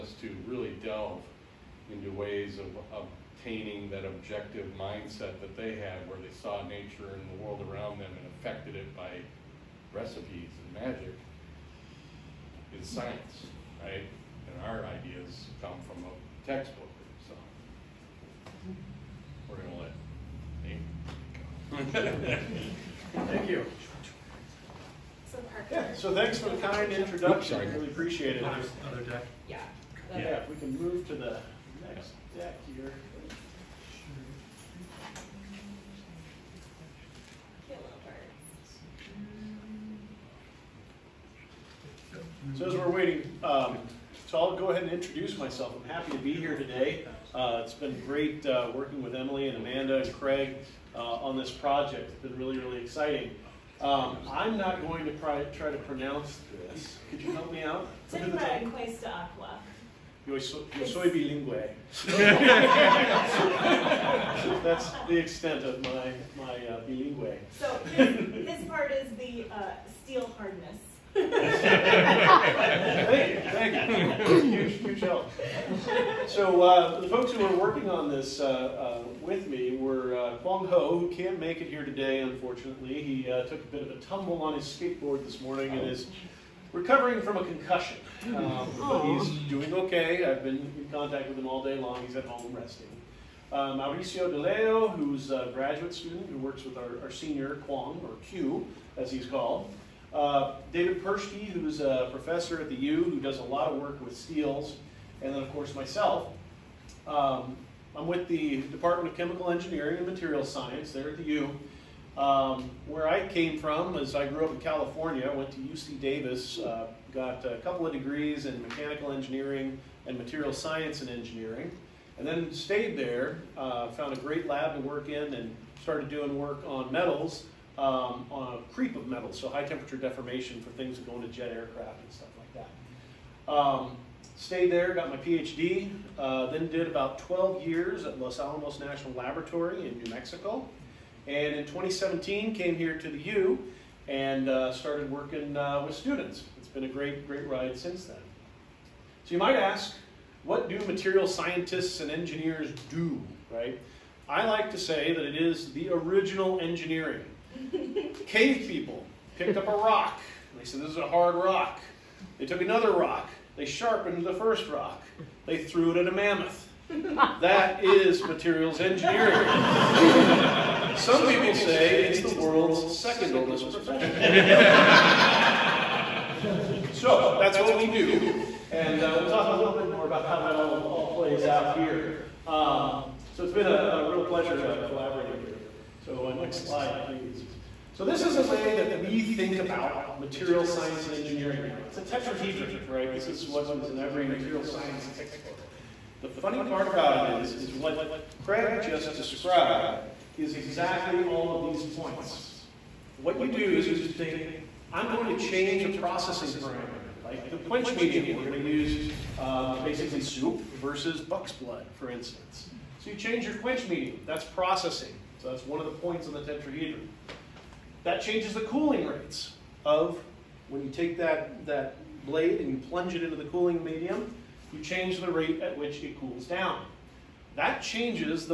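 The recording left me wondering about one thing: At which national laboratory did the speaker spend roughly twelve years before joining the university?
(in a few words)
Los Alamos National Laboratory.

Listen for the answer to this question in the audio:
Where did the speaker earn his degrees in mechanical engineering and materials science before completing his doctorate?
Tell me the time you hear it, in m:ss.
1:55.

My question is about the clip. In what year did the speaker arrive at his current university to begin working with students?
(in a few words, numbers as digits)
2017.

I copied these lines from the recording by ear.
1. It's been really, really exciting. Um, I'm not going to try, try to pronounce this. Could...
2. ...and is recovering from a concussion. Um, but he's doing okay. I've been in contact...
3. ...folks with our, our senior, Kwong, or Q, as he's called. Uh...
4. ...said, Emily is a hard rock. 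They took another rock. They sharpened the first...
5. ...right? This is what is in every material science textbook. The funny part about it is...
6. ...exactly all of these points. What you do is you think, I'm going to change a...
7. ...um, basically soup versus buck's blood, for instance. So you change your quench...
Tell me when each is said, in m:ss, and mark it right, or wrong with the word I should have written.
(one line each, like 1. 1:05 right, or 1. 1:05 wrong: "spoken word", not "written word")
1. 0:52 right
2. 1:25 right
3. 1:36 wrong: "works", not "folks"
4. 2:40 wrong: "This", not "Emily"
5. 3:12 right
6. 3:20 right
7. 3:29 right.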